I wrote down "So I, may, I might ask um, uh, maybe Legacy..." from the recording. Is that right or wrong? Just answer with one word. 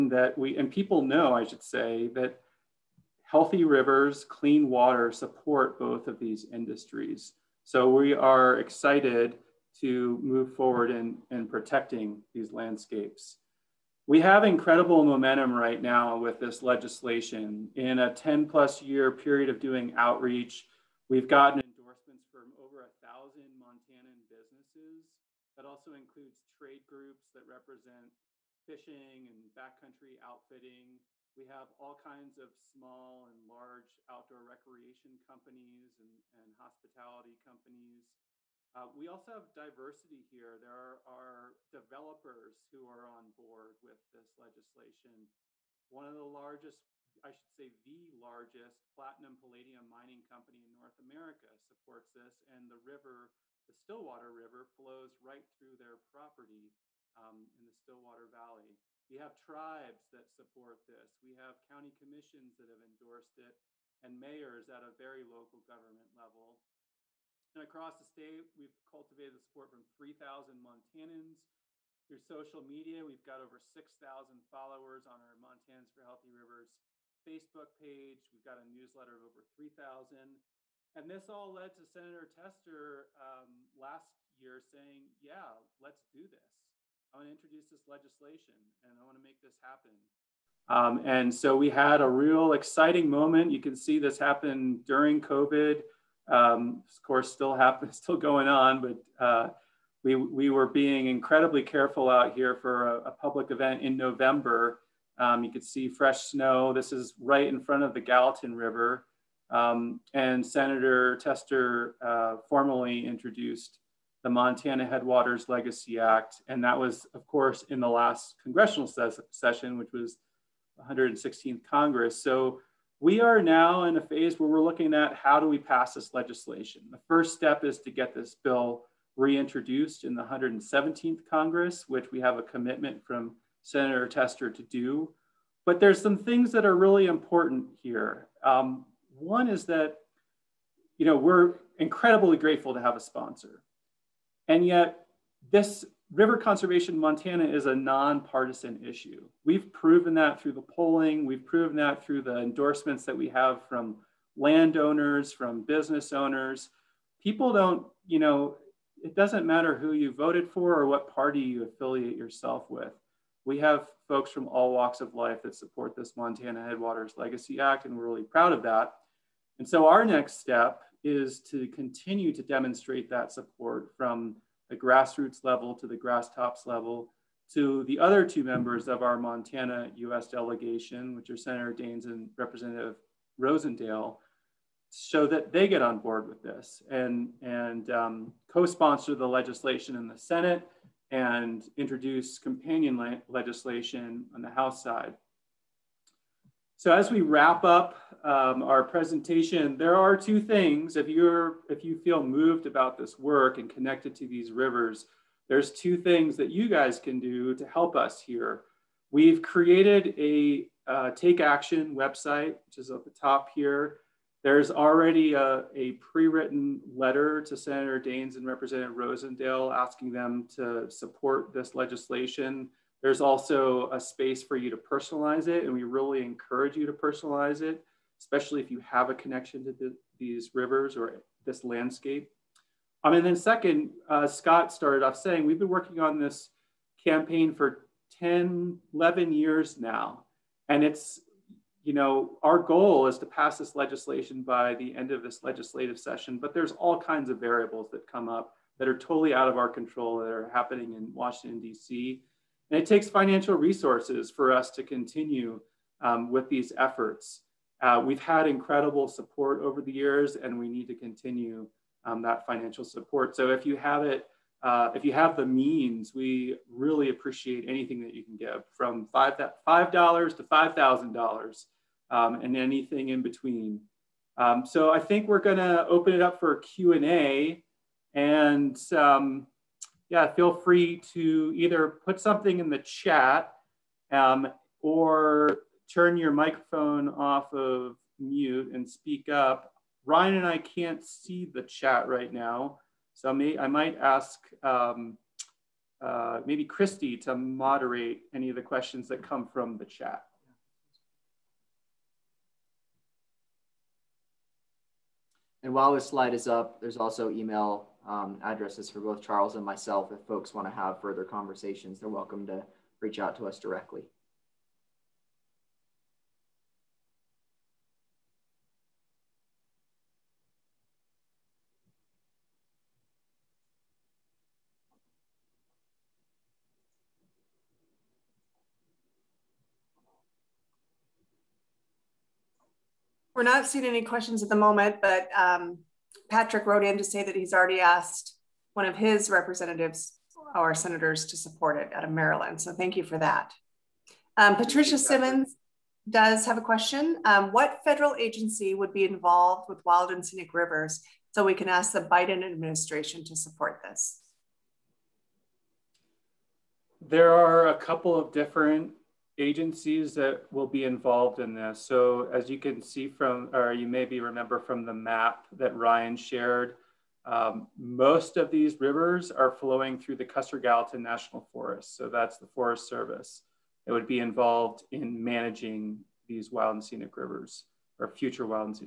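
wrong.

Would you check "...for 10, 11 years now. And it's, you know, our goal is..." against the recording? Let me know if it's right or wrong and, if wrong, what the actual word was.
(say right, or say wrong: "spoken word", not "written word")
right.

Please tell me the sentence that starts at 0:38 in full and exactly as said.
Uh, we also have diversity here.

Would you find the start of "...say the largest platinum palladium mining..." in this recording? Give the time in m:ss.
0:47.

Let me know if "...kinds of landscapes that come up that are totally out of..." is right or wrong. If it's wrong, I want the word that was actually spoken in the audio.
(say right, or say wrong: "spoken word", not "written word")
wrong: "variables", not "landscapes".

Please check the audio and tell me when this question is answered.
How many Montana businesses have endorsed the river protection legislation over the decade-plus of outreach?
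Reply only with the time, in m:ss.
0:22.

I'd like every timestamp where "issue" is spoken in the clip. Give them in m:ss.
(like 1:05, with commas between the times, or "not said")
2:28.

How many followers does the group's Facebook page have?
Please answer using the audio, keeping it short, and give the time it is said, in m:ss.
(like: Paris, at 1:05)
over 6,000, at 1:13.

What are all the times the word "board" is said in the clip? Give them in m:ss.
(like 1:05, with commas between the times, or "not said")
0:43, 3:05.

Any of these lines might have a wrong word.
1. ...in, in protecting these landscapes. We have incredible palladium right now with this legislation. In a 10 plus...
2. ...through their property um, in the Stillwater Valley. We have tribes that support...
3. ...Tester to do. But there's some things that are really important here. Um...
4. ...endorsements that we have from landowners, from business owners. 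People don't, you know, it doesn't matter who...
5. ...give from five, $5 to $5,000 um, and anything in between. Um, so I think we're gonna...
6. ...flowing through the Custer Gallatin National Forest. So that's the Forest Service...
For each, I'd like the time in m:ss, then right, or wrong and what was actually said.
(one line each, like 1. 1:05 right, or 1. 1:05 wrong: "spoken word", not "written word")
1. 0:10 wrong: "momentum", not "palladium"
2. 0:55 right
3. 2:14 right
4. 2:32 right
5. 4:28 right
6. 6:09 right.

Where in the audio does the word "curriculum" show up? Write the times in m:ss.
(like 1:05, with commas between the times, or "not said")
not said.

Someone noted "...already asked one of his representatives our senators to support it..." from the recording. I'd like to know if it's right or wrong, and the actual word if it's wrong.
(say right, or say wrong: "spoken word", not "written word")
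right.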